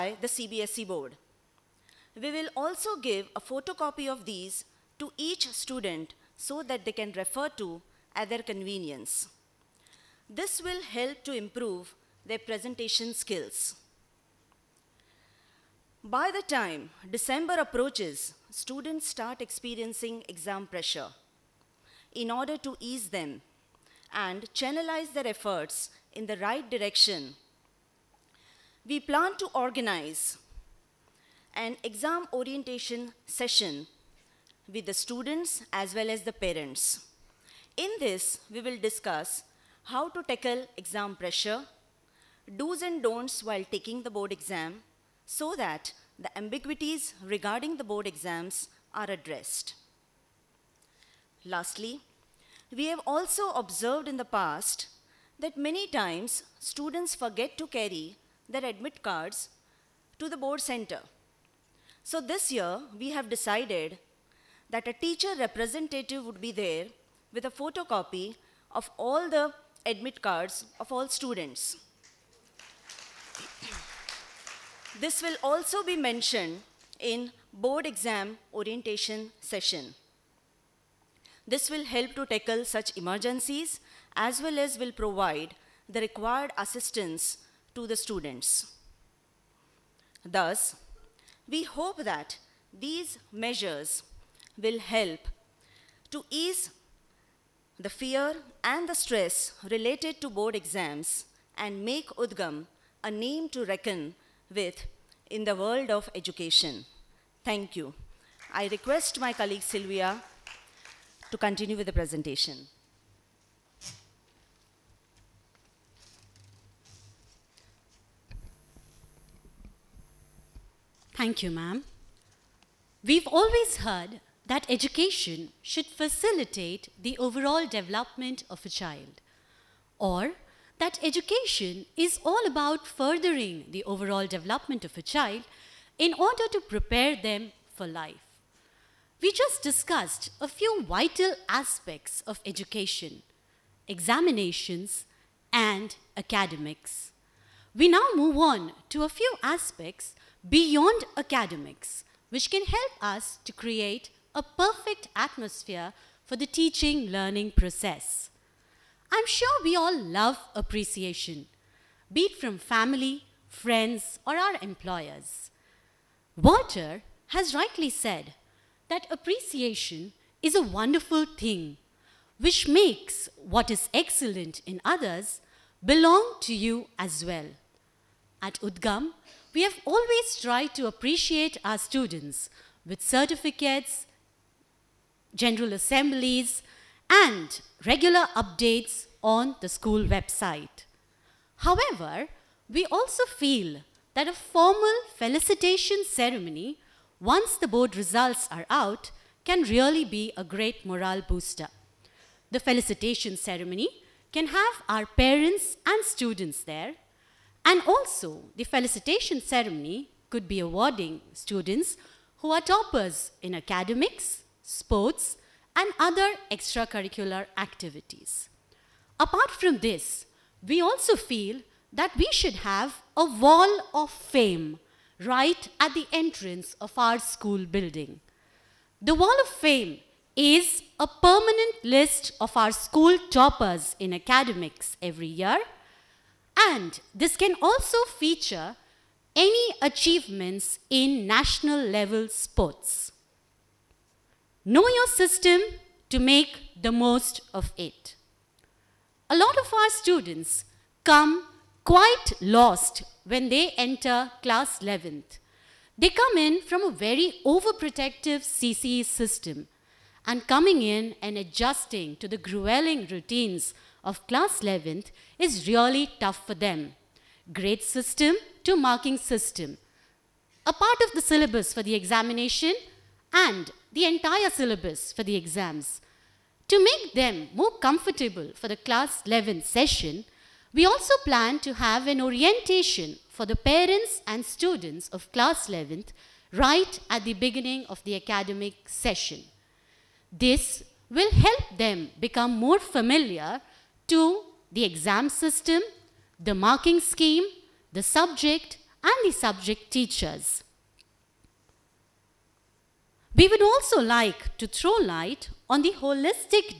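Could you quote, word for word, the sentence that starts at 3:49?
The wall of fame is a permanent list of our school toppers in academics every year.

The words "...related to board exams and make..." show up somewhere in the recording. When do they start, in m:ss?
1:39.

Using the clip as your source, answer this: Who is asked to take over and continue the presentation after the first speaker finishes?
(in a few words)
Sylvia.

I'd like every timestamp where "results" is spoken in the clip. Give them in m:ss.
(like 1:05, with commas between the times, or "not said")
3:17.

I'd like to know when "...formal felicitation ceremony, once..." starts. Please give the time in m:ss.
3:14.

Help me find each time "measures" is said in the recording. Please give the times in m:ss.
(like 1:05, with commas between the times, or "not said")
1:33.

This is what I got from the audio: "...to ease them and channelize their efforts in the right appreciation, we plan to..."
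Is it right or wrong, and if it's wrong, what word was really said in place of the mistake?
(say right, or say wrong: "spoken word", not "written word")
wrong: "direction", not "appreciation".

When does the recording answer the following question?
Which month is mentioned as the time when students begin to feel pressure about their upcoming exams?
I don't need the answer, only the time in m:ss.
0:17.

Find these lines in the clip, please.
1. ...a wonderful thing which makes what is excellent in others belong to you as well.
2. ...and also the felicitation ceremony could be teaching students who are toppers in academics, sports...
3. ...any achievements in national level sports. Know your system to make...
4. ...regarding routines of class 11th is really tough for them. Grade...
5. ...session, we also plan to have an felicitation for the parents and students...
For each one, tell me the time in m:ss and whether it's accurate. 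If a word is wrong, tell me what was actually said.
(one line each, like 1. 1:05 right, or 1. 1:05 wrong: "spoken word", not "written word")
1. 2:50 right
2. 3:27 wrong: "awarding", not "teaching"
3. 3:59 right
4. 4:22 wrong: "grueling", not "regarding"
5. 4:39 wrong: "orientation", not "felicitation".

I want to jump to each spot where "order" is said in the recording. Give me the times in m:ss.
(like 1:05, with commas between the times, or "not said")
0:22, 2:16.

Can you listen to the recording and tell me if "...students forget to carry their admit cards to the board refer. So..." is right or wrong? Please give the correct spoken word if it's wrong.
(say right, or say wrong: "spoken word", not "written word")
wrong: "center", not "refer".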